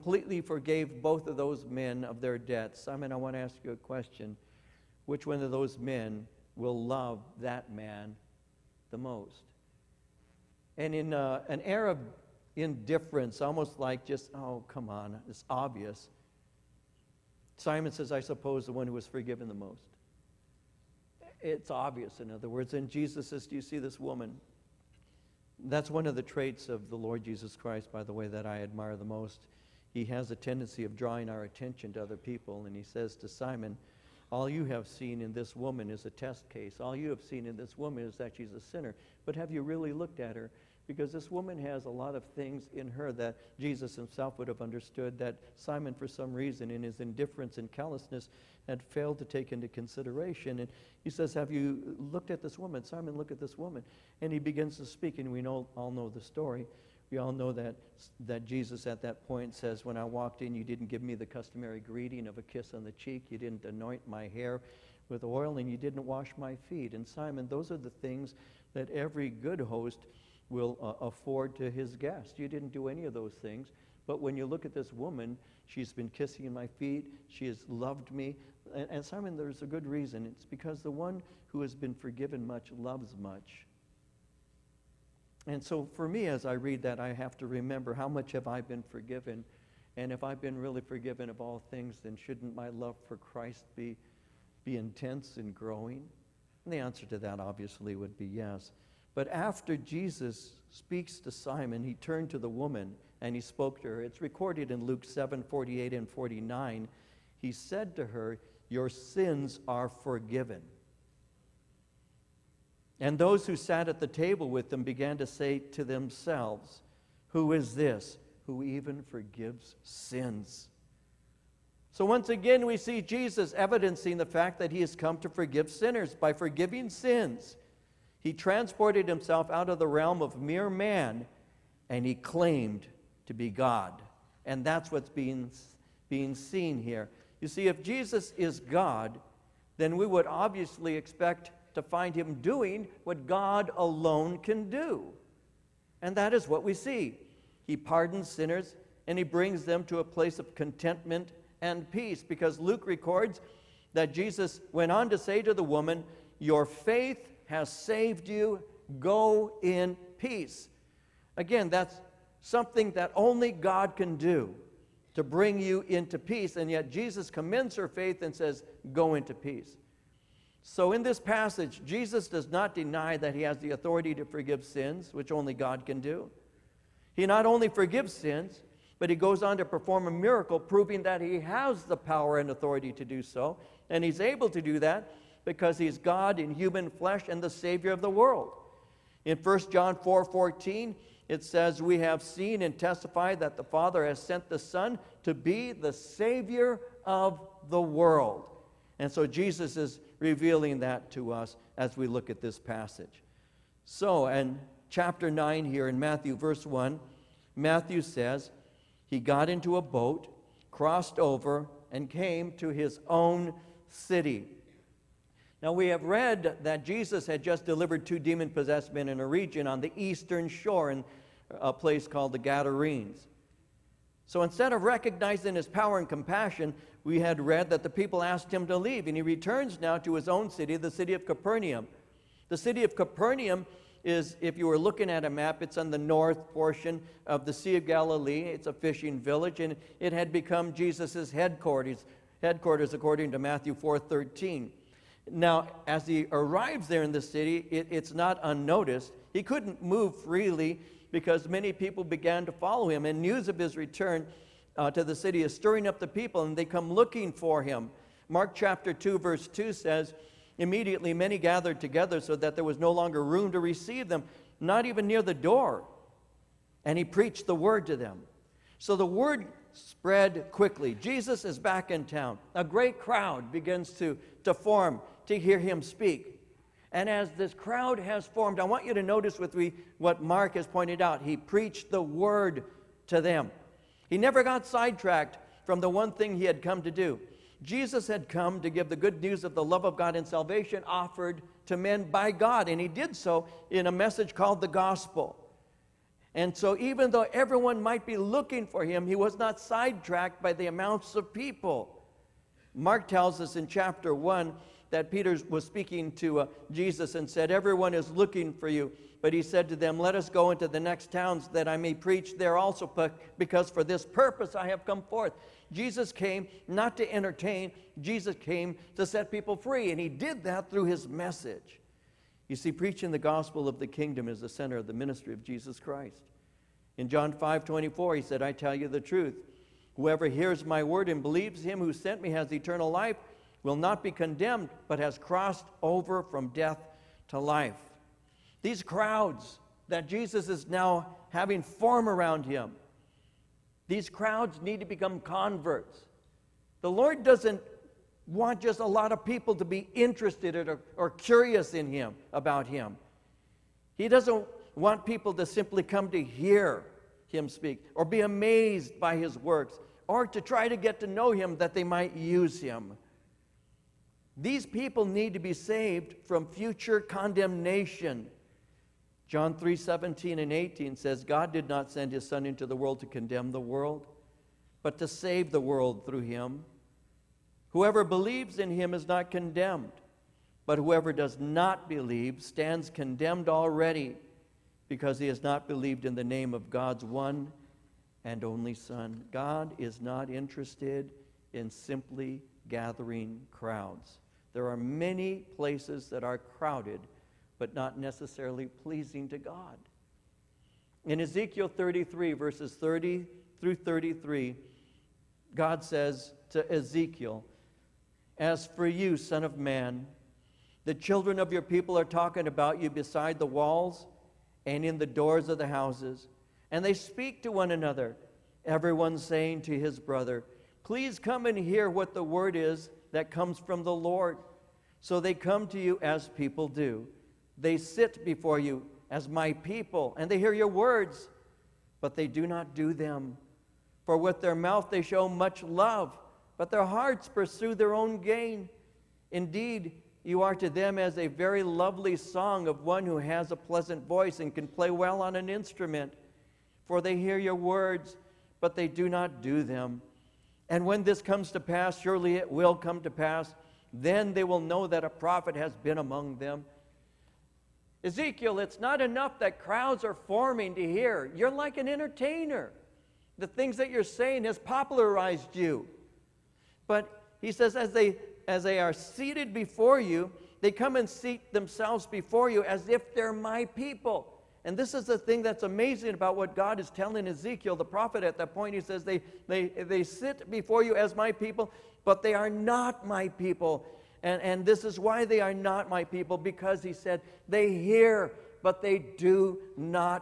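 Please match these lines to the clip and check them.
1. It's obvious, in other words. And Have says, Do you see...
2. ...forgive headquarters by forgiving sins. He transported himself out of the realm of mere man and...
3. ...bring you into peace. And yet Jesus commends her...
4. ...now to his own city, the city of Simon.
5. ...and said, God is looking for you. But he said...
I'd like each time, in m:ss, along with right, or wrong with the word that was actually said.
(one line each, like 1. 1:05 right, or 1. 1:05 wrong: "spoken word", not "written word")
1. 0:21 wrong: "Jesus", not "Have"
2. 2:05 wrong: "sinners", not "headquarters"
3. 2:45 right
4. 3:49 wrong: "Capernaum", not "Simon"
5. 5:07 wrong: "Everyone", not "God".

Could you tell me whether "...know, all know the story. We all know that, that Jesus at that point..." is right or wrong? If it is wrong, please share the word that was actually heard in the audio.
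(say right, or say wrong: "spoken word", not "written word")
right.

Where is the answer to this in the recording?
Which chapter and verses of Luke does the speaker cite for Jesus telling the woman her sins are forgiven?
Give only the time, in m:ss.
1:44.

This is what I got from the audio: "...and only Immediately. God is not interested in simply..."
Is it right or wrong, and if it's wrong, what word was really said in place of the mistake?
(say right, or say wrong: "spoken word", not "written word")
wrong: "Son", not "Immediately".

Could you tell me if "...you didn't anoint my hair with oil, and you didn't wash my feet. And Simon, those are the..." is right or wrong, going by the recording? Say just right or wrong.
right.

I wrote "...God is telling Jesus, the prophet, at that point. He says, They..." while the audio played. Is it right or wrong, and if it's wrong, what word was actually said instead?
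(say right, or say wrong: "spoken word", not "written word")
wrong: "Ezekiel", not "Jesus".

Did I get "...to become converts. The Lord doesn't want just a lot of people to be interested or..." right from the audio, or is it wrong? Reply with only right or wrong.
right.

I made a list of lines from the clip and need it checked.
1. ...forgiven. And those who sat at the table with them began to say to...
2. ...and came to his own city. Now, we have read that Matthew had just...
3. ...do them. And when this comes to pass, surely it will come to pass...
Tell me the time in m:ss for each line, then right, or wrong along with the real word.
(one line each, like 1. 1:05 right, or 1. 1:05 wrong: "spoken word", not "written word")
1. 1:49 right
2. 3:31 wrong: "Jesus", not "Matthew"
3. 7:29 right.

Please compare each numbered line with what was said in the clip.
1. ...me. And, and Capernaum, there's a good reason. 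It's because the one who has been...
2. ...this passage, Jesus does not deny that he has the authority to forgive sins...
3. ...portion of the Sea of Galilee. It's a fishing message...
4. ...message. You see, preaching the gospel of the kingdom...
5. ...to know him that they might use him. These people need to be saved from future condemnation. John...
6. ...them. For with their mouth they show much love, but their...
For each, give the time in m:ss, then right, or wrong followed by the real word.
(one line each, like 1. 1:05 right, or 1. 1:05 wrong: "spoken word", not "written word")
1. 1:18 wrong: "Simon", not "Capernaum"
2. 2:51 right
3. 3:56 wrong: "village", not "message"
4. 5:21 right
5. 6:00 right
6. 7:12 right.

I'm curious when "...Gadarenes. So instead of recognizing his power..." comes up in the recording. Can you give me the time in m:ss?
3:42.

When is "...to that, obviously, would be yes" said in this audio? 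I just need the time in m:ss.
1:37.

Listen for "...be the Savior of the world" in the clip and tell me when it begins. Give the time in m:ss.
3:15.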